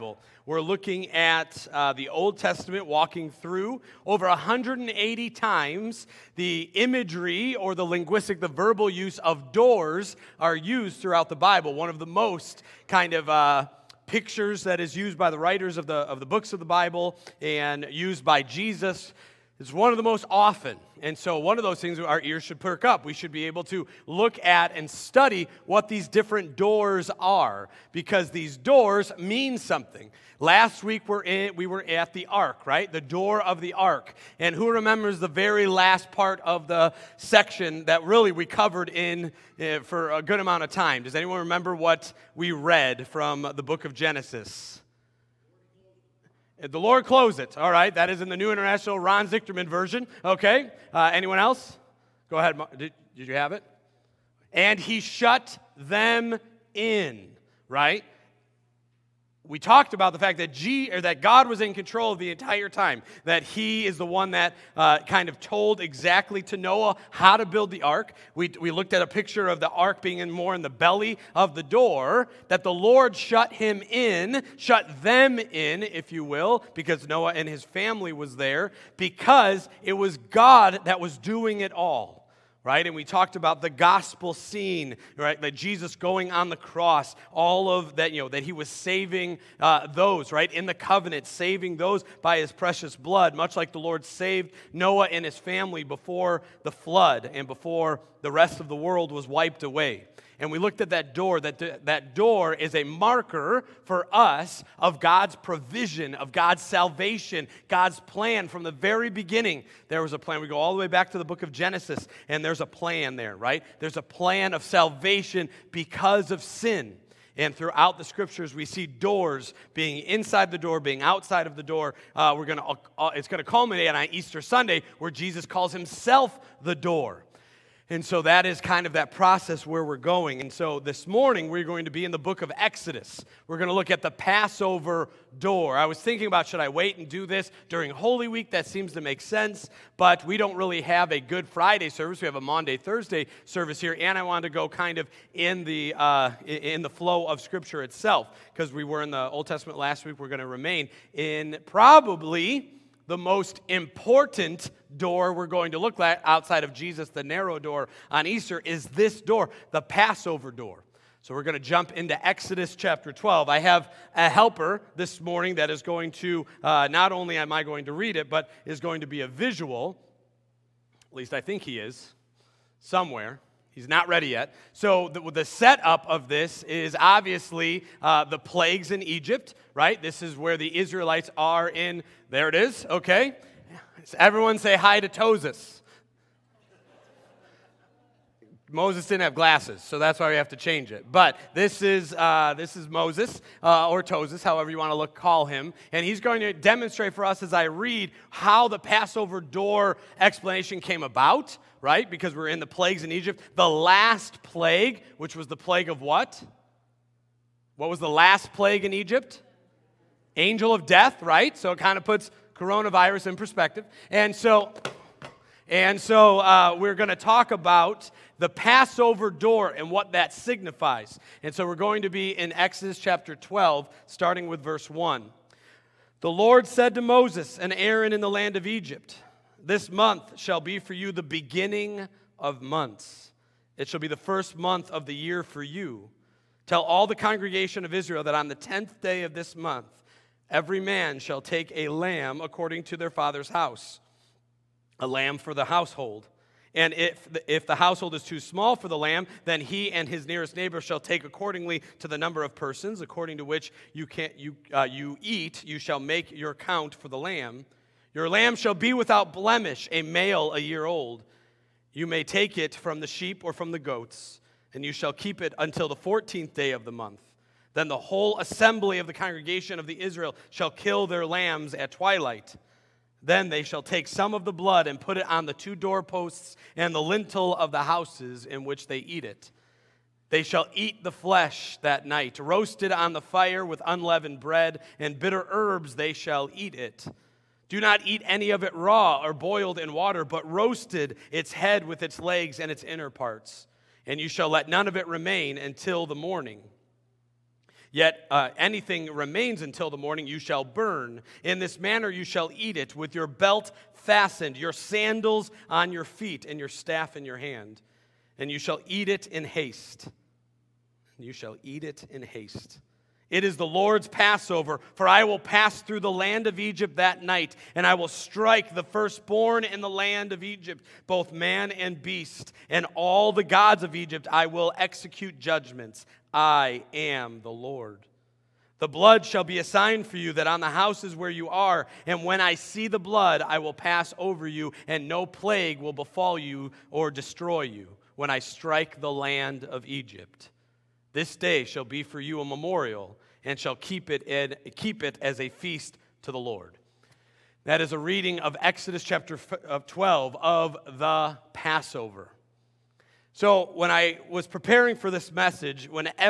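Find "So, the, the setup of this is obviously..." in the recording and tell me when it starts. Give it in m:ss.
2:54.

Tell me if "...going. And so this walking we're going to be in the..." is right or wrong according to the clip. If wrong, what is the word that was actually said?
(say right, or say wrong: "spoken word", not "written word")
wrong: "morning", not "walking".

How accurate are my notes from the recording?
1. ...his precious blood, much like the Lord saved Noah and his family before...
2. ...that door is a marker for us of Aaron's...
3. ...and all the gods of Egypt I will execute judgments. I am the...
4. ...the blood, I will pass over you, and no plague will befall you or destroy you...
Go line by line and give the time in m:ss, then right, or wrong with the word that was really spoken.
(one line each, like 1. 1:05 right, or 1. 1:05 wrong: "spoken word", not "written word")
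1. 1:32 right
2. 1:41 wrong: "God", not "Aaron"
3. 5:22 right
4. 5:32 right.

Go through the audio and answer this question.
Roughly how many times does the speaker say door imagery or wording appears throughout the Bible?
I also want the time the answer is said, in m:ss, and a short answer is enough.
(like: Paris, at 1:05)
180, at 0:04.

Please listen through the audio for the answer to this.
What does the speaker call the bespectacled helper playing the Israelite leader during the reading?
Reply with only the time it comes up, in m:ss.
3:05.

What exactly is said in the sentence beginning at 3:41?
And so we're going to be in Exodus chapter 12, starting with verse 1.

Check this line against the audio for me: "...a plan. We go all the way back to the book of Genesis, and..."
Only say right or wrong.
right.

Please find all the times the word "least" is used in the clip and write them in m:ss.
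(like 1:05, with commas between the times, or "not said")
2:51.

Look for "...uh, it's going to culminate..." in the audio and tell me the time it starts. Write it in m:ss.
2:02.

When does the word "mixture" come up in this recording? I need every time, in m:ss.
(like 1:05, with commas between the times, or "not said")
not said.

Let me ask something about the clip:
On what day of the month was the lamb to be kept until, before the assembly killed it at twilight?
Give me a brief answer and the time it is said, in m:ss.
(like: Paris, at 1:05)
14th, at 4:25.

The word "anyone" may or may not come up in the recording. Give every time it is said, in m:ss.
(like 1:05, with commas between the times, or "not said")
0:41, 0:51.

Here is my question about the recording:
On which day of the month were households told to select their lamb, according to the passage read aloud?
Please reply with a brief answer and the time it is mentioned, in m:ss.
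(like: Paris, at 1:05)
10th, at 3:58.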